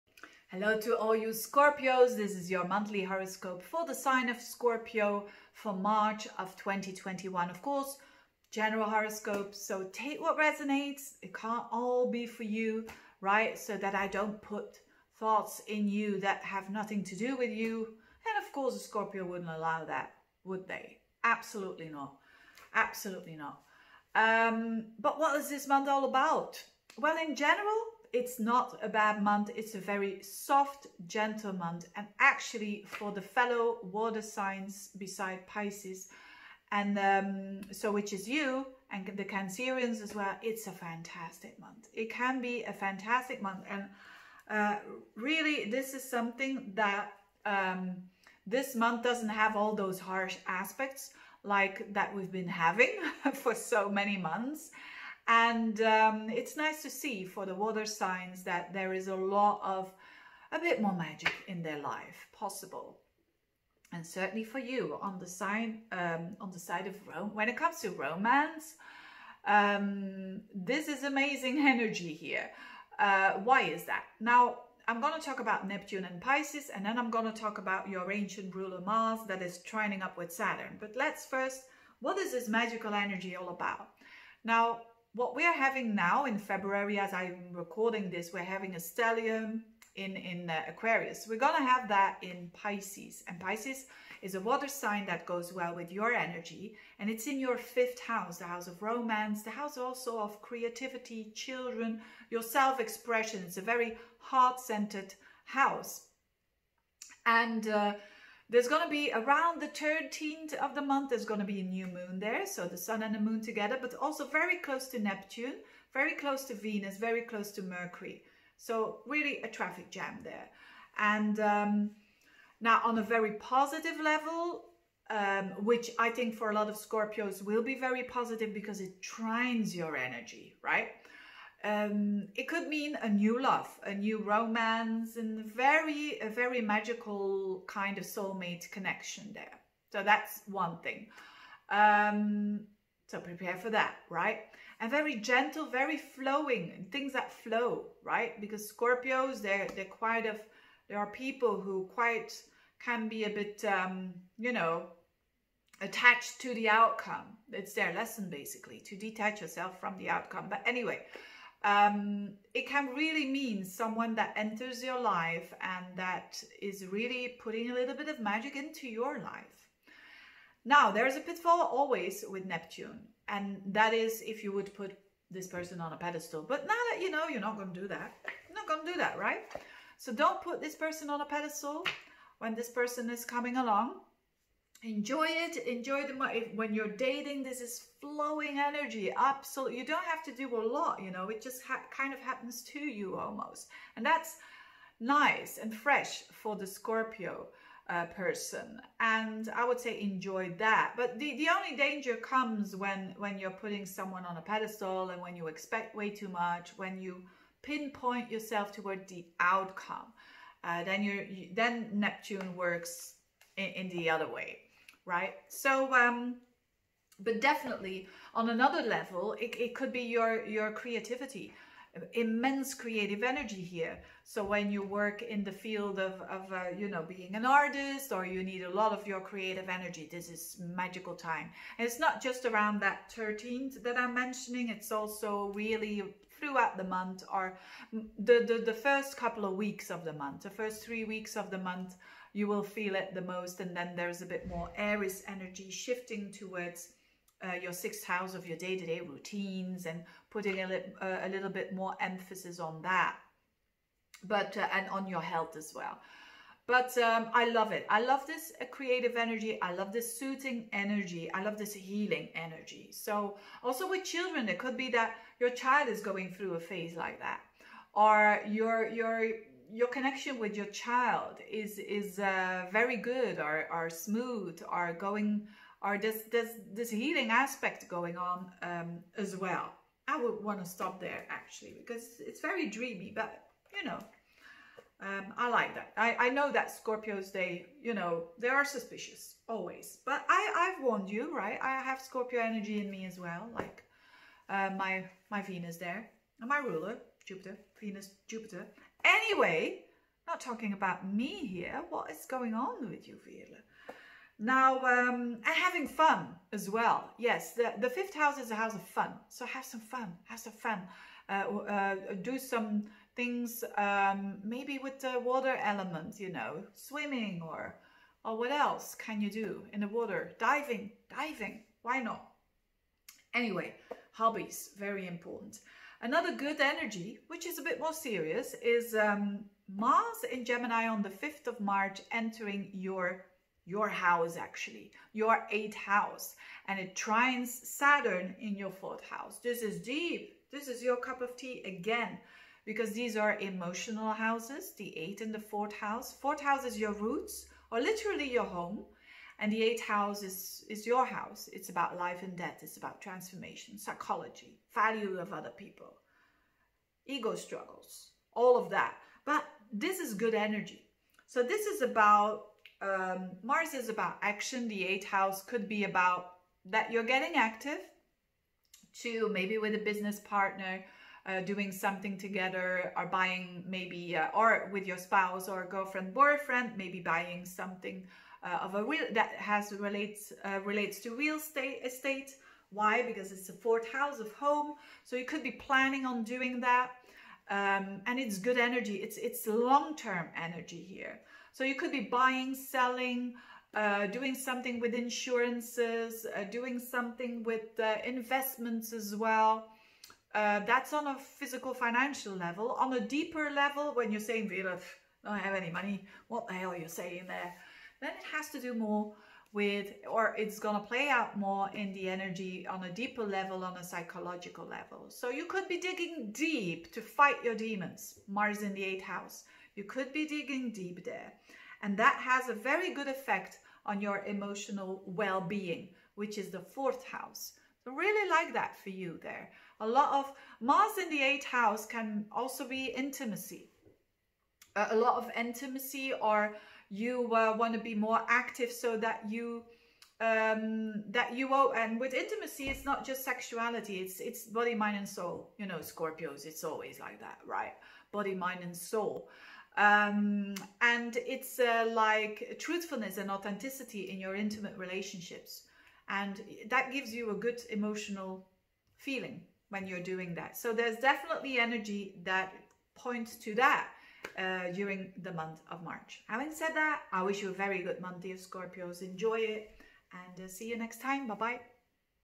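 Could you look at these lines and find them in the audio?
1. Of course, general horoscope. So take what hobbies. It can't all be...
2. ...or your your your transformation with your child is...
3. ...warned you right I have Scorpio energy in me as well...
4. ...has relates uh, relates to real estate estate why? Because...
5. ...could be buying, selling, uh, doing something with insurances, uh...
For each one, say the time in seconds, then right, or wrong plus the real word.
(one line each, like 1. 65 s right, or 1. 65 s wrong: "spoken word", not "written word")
1. 7 s wrong: "resonates", not "hobbies"
2. 268 s wrong: "connection", not "transformation"
3. 290 s right
4. 379 s right
5. 391 s right.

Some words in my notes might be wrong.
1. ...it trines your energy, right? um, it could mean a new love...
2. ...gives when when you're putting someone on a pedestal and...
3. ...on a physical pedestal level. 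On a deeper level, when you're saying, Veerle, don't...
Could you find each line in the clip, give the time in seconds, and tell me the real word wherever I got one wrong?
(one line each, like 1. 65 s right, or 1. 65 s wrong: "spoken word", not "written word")
1. 128 s right
2. 202 s wrong: "comes", not "gives"
3. 400 s wrong: "financial", not "pedestal".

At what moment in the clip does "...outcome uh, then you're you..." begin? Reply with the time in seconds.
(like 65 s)
209 s.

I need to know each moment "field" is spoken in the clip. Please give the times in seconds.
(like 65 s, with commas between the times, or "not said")
225 s.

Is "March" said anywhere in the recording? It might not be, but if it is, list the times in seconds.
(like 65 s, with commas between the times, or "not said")
5 s, 331 s, 465 s.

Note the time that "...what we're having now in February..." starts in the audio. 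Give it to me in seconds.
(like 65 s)
85 s.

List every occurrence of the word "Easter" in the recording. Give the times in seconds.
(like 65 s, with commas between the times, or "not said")
not said.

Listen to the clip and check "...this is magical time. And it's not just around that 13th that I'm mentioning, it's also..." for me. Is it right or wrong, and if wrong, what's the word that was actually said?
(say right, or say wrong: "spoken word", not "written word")
right.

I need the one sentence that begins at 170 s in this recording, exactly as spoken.
Now, there's a pitfall always with Neptune, and that is if you would put this person on a pedestal.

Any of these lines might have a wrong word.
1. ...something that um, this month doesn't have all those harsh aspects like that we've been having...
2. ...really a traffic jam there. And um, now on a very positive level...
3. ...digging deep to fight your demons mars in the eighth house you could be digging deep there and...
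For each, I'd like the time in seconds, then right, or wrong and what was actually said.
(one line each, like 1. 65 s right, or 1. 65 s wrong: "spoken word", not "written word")
1. 46 s right
2. 119 s right
3. 415 s right.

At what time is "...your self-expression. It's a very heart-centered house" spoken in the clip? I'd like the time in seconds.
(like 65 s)
102 s.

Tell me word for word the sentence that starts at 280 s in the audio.
I would want to stop there actually because it's very dreamy but you know um, I like that.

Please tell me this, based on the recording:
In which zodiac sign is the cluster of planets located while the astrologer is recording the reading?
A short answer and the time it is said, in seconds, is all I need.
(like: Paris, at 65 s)
Aquarius, at 90 s.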